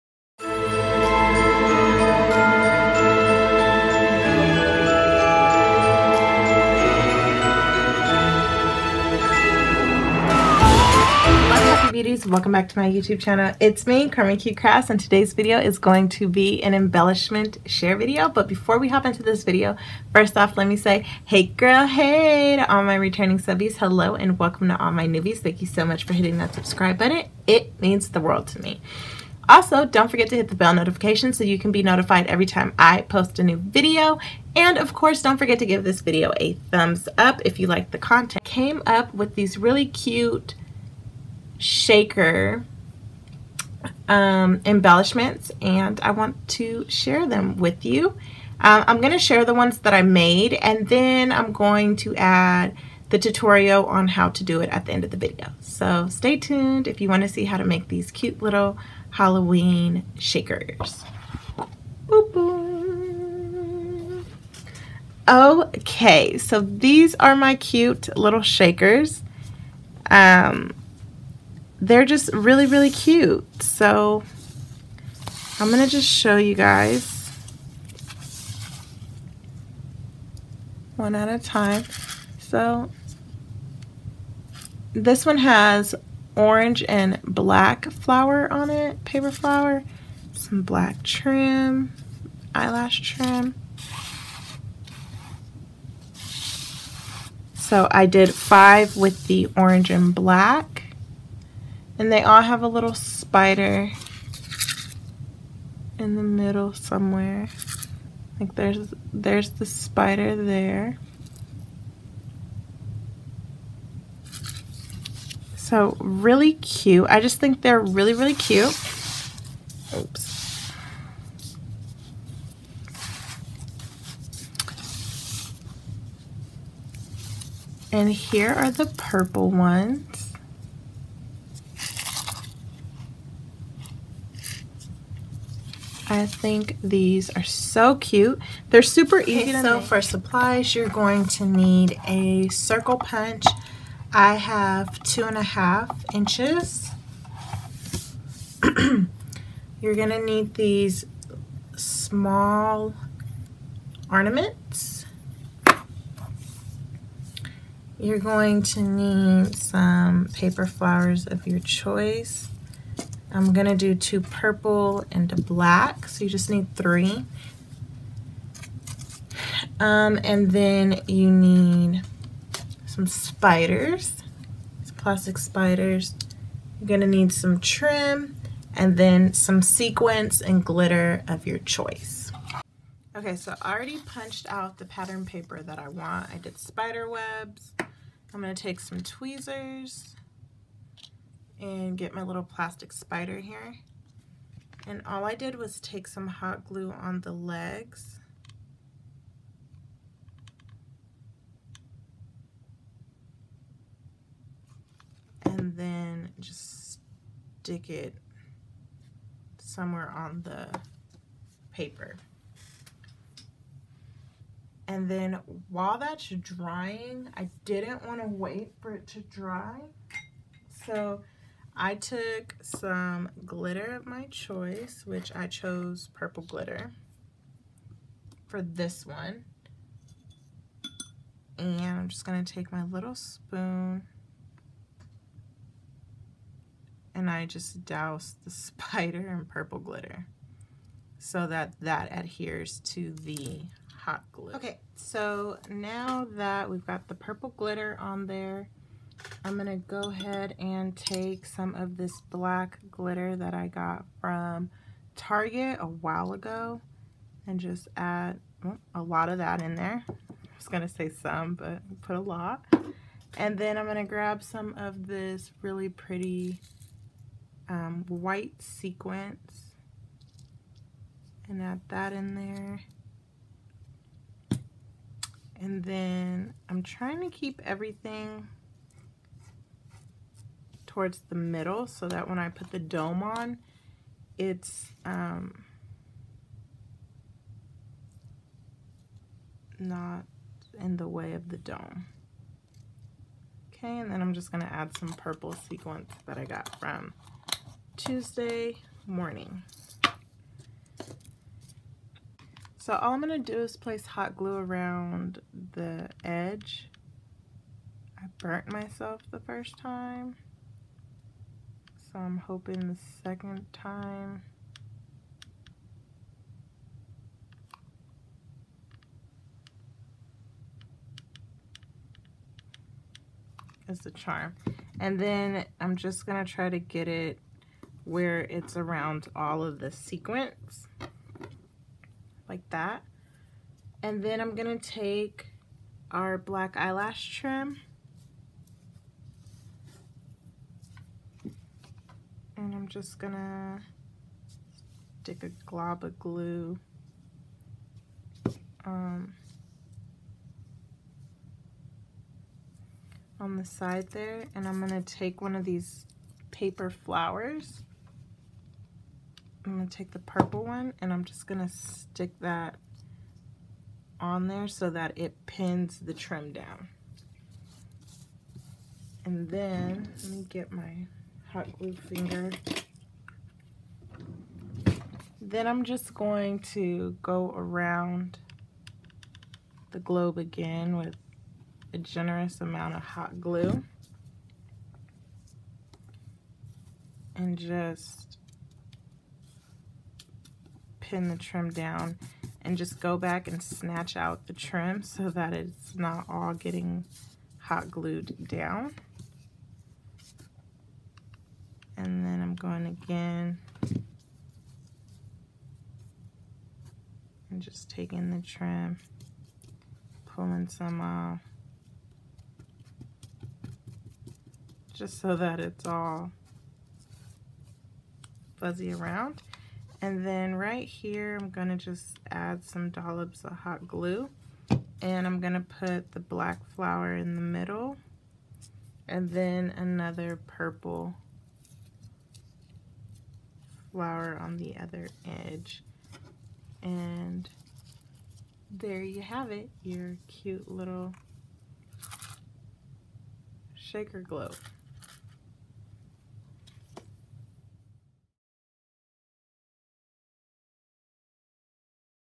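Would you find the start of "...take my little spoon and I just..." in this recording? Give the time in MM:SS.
03:52.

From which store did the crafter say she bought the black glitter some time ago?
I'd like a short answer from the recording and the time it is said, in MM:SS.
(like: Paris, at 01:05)
Target, at 04:15.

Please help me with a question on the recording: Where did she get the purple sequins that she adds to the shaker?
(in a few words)
Tuesday Morning.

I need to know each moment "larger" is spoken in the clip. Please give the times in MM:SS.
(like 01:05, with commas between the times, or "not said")
not said.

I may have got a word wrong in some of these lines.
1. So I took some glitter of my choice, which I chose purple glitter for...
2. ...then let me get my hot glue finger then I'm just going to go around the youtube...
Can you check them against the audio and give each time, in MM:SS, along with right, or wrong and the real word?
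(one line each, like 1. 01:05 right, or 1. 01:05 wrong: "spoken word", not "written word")
1. 03:40 right
2. 06:09 wrong: "globe", not "youtube".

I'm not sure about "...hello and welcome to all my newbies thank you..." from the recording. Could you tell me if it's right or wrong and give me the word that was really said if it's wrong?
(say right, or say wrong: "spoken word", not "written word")
right.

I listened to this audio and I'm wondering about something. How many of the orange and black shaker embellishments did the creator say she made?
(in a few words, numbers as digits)
5.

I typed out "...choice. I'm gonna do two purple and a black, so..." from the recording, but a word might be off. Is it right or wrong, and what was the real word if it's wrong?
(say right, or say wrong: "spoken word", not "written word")
right.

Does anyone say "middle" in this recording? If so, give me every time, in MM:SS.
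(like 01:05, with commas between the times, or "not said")
01:46, 04:41, 07:07.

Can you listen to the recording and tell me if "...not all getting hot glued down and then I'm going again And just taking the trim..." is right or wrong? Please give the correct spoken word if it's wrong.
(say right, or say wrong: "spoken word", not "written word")
right.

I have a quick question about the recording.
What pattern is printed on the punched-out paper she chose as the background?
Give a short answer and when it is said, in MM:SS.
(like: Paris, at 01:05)
Spider webs, at 03:06.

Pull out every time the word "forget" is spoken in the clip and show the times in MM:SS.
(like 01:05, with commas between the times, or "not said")
00:30, 00:35.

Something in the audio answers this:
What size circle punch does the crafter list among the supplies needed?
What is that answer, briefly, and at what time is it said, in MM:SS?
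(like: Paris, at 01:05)
2.5 inches, at 02:25.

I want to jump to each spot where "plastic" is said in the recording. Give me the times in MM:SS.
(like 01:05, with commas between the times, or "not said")
02:54, 03:12.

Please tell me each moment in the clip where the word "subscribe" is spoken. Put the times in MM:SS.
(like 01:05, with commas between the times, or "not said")
00:26.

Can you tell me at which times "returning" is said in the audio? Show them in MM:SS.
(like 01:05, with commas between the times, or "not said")
00:22.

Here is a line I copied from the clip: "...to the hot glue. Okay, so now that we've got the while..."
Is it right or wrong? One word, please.
wrong.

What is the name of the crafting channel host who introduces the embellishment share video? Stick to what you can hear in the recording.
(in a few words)
Carmen Q Crafts.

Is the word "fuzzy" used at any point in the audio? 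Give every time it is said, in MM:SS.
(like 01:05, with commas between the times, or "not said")
06:58.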